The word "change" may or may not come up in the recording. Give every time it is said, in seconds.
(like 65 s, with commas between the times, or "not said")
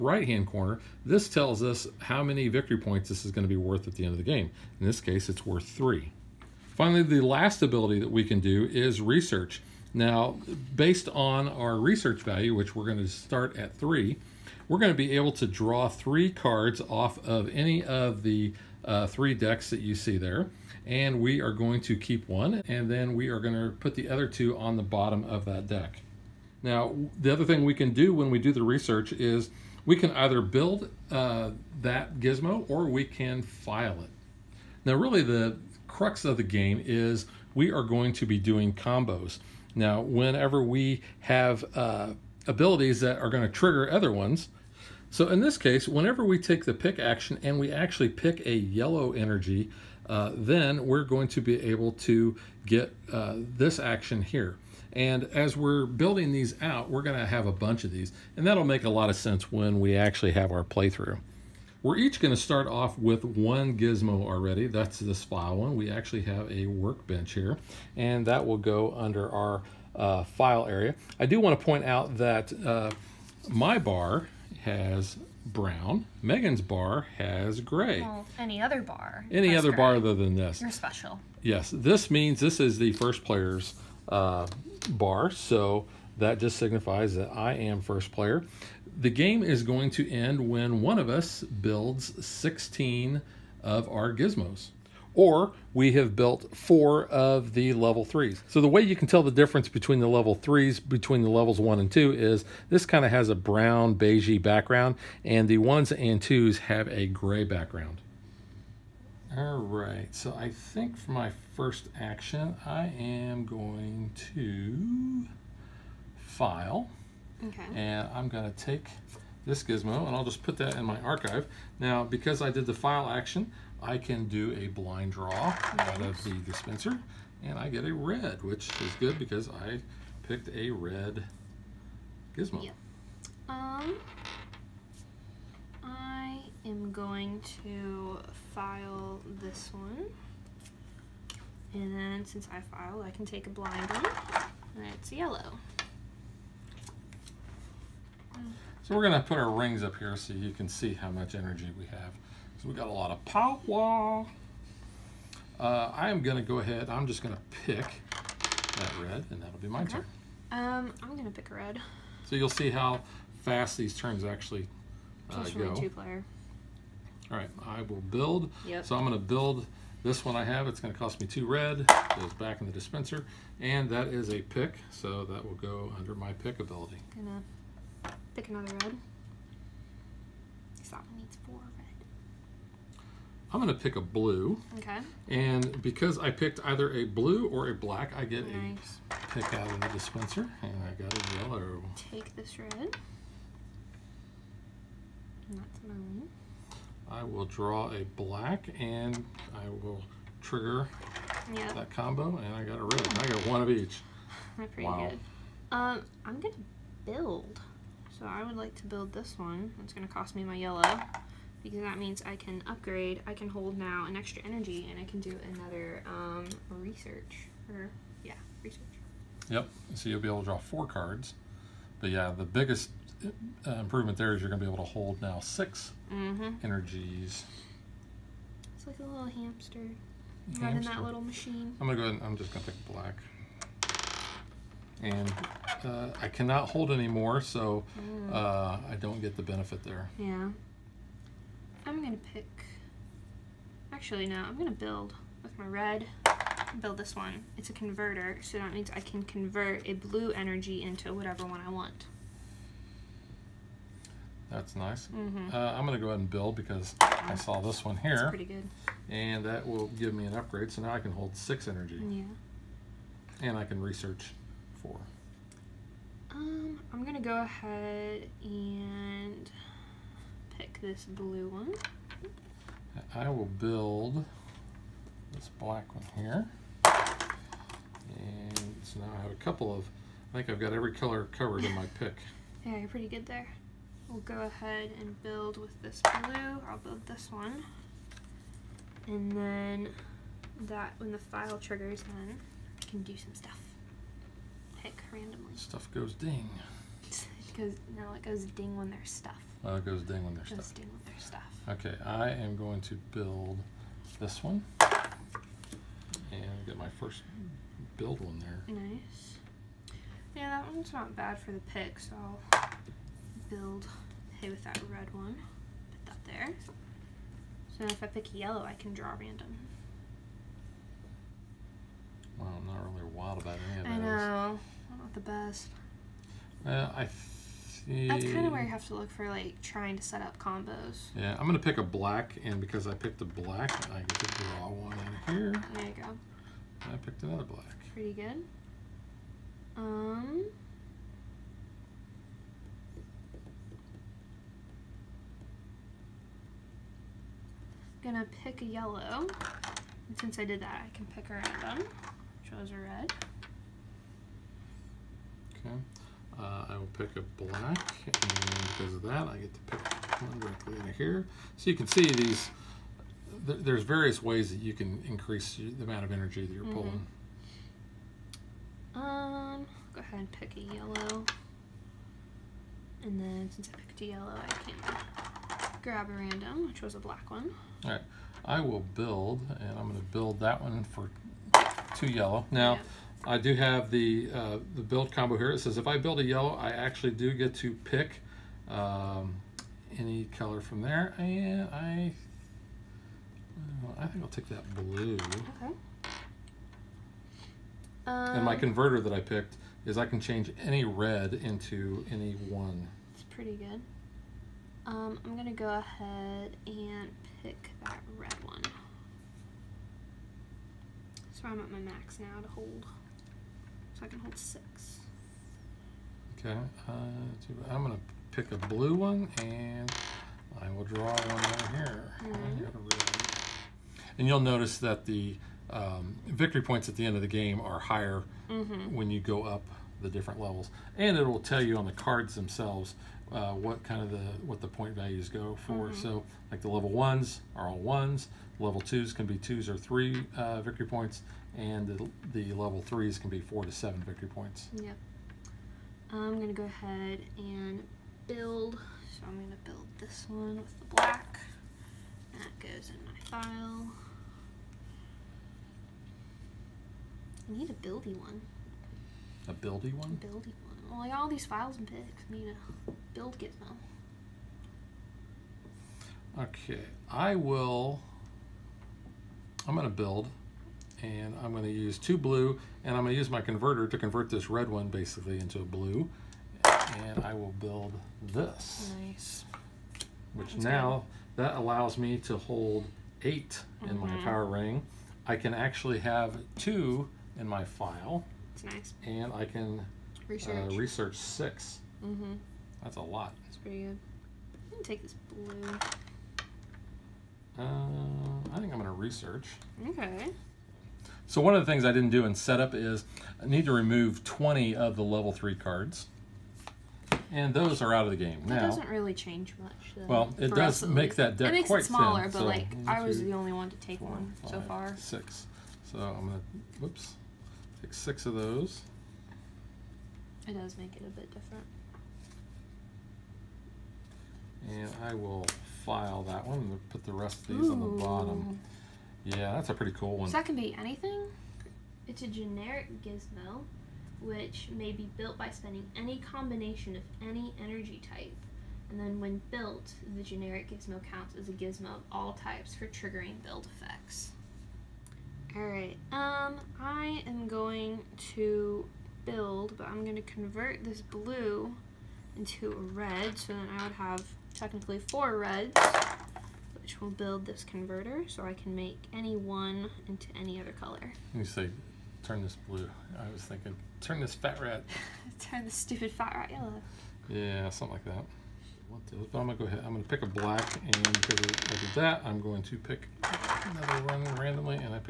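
400 s, 509 s.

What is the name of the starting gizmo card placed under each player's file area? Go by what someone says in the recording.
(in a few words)
workbench.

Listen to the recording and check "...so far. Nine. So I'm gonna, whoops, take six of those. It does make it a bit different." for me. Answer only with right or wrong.
wrong.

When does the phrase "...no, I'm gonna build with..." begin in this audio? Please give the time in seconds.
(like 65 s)
244 s.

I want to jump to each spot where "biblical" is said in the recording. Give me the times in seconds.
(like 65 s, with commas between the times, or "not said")
not said.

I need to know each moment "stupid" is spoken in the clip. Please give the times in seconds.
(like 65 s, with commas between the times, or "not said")
565 s.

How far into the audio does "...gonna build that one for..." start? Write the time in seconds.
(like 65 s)
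379 s.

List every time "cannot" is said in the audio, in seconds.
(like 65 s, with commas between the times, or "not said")
236 s.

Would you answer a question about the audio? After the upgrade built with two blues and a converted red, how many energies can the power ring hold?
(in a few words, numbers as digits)
8.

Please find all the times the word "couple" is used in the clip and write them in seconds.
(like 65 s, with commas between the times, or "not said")
279 s.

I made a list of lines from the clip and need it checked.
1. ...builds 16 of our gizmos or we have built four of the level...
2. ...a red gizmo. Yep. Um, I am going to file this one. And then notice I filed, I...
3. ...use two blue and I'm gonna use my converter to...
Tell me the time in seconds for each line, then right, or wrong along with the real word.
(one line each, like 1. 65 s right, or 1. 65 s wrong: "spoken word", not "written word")
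1. 91 s right
2. 130 s wrong: "since", not "notice"
3. 471 s right.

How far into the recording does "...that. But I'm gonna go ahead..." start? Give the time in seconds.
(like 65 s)
568 s.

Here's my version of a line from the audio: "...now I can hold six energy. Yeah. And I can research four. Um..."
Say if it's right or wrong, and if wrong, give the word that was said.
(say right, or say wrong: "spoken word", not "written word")
right.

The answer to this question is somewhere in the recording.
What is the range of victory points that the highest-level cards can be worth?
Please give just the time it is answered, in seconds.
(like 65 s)
443 s.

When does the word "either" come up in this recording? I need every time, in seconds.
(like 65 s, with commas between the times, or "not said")
30 s, 186 s.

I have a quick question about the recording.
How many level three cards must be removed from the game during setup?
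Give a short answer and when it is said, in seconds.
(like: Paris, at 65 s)
20, at 504 s.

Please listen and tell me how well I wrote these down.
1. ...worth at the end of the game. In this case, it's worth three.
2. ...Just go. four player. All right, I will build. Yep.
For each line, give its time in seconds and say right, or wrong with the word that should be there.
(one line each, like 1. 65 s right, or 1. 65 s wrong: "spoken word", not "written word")
1. 3 s right
2. 165 s wrong: "two", not "four".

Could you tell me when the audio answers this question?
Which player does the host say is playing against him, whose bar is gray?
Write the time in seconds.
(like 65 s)
76 s.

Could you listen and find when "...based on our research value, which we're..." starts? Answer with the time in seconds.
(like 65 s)
10 s.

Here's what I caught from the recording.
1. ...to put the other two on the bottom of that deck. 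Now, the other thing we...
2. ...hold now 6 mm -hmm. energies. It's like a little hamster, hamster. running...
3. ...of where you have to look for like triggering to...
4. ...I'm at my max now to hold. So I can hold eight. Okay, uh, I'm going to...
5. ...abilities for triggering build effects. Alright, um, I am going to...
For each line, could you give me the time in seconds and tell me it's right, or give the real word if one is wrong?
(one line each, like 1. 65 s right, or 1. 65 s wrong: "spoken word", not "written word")
1. 23 s right
2. 224 s right
3. 328 s wrong: "trying", not "triggering"
4. 411 s wrong: "six", not "eight"
5. 542 s wrong: "types", not "abilities".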